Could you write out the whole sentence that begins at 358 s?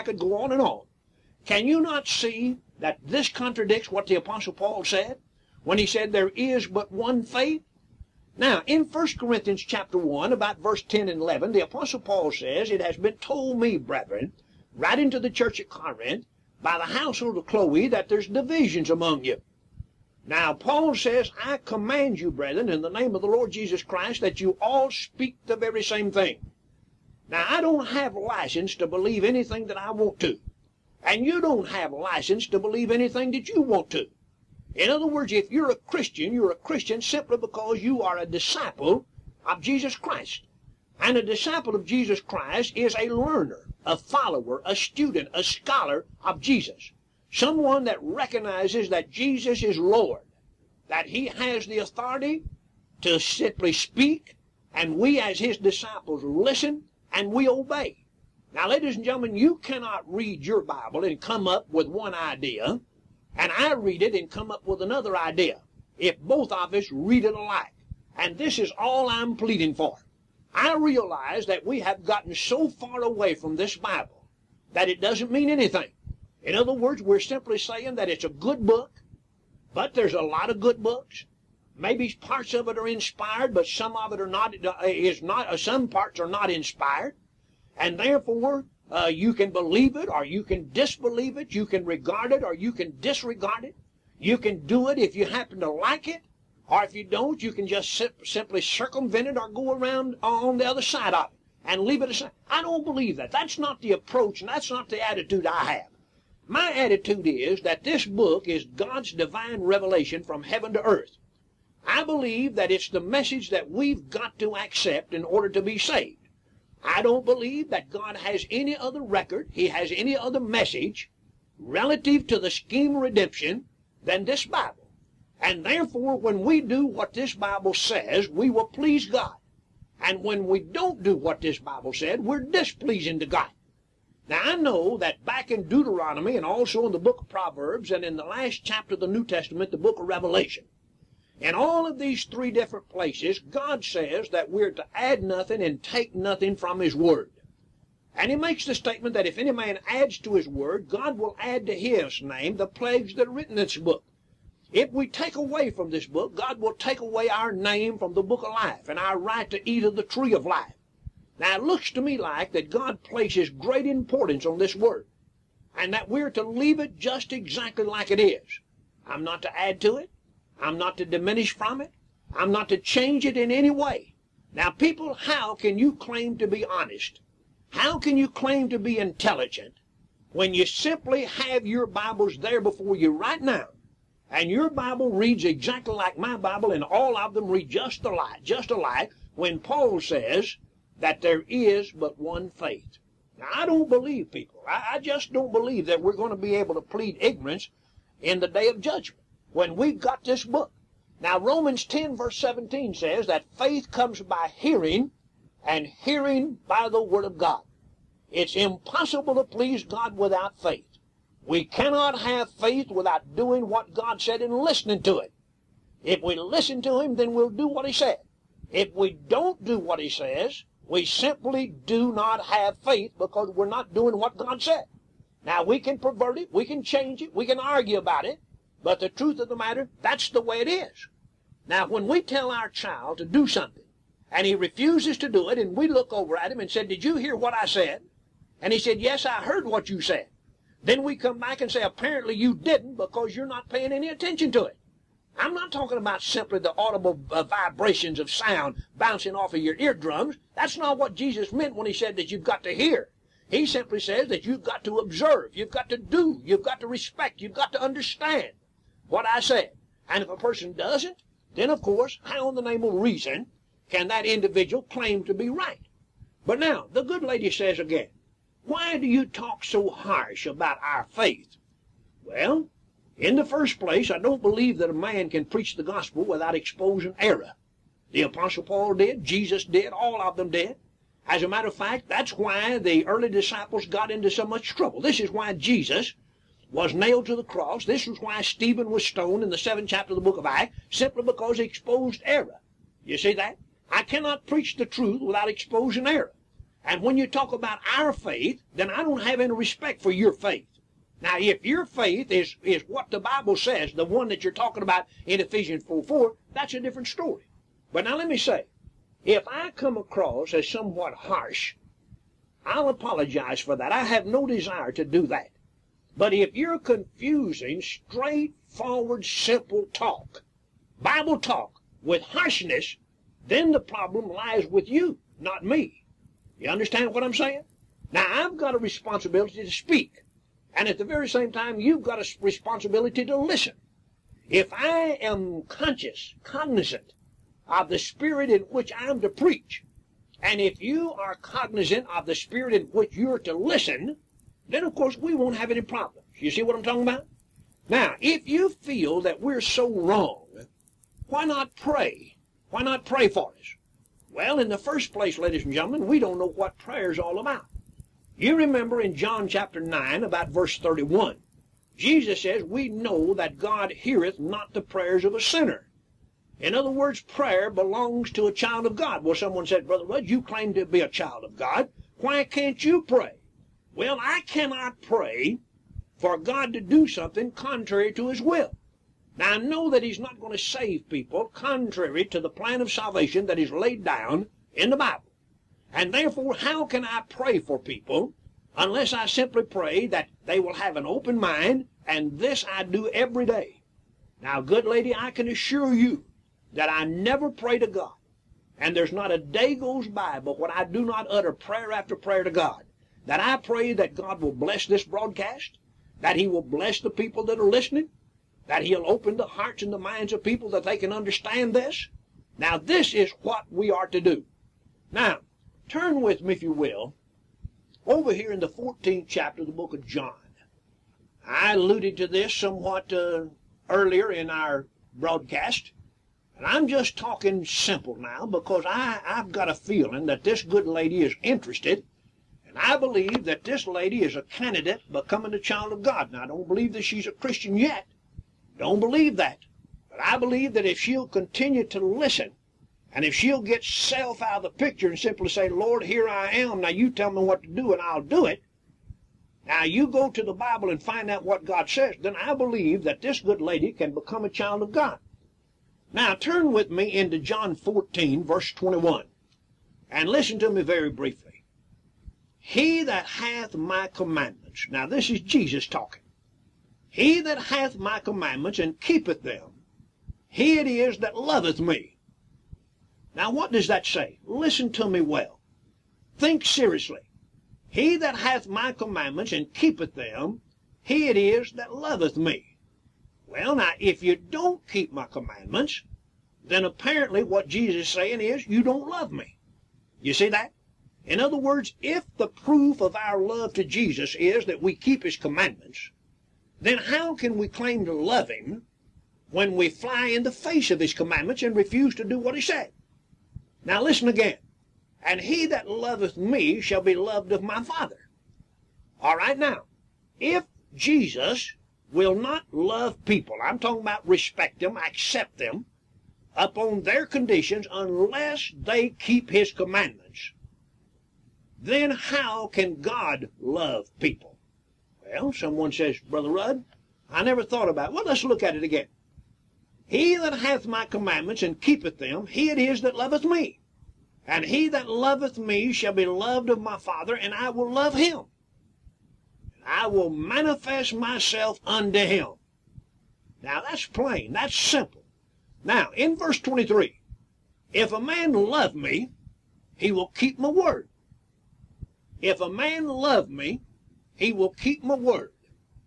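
You remember in John chapter 9 about verse 31, Jesus says, We know that God heareth not the prayers of a sinner.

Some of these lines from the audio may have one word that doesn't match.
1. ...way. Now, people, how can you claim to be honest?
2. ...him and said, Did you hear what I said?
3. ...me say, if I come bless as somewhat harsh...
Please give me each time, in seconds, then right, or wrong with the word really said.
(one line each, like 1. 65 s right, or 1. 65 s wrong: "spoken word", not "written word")
1. 173 s right
2. 236 s right
3. 308 s wrong: "across", not "bless".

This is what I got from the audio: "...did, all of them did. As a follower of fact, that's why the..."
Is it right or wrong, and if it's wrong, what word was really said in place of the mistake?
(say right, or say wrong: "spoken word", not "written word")
wrong: "matter", not "follower".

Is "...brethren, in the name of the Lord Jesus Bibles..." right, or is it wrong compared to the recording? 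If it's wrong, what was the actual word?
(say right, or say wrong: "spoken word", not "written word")
wrong: "Christ", not "Bibles".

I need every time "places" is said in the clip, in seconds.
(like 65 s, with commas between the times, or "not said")
142 s, 163 s, 273 s, 355 s.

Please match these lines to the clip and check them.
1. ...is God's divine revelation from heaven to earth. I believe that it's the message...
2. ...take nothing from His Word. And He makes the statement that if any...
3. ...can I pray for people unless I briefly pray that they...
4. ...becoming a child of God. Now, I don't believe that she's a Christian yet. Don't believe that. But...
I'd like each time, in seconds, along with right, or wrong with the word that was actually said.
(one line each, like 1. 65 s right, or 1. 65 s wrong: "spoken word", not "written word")
1. 108 s right
2. 145 s right
3. 386 s wrong: "simply", not "briefly"
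4. 435 s right.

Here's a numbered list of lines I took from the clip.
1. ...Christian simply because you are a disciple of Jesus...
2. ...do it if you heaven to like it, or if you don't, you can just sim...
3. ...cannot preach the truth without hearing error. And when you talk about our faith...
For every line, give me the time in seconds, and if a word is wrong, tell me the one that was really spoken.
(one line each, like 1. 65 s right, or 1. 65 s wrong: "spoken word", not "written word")
1. 36 s right
2. 94 s wrong: "happen", not "heaven"
3. 294 s wrong: "exposing", not "hearing".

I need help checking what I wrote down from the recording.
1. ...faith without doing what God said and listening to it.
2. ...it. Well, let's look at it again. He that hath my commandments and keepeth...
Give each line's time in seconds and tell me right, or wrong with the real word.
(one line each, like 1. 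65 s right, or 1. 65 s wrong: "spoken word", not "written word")
1. 212 s right
2. 528 s right.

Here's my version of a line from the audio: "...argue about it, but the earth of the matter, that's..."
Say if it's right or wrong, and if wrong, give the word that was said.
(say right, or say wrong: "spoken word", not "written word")
wrong: "truth", not "earth".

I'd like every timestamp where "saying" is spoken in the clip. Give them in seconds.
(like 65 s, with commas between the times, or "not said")
77 s, 327 s, 488 s.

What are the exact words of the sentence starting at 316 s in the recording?
But if you're confusing straightforward, simple talk, Bible talk, with harshness, then the problem lies with you, not me.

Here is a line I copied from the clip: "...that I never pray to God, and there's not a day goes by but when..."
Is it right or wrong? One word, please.
right.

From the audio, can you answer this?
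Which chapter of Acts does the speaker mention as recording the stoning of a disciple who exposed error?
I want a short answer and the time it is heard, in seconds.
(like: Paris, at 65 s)
Chapter 7, at 289 s.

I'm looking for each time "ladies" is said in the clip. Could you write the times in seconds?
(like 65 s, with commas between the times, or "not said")
58 s, 355 s.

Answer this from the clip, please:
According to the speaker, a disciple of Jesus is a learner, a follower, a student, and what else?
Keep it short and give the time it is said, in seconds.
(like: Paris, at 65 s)
a scholar, at 45 s.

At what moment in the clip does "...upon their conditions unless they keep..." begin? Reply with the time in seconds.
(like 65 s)
516 s.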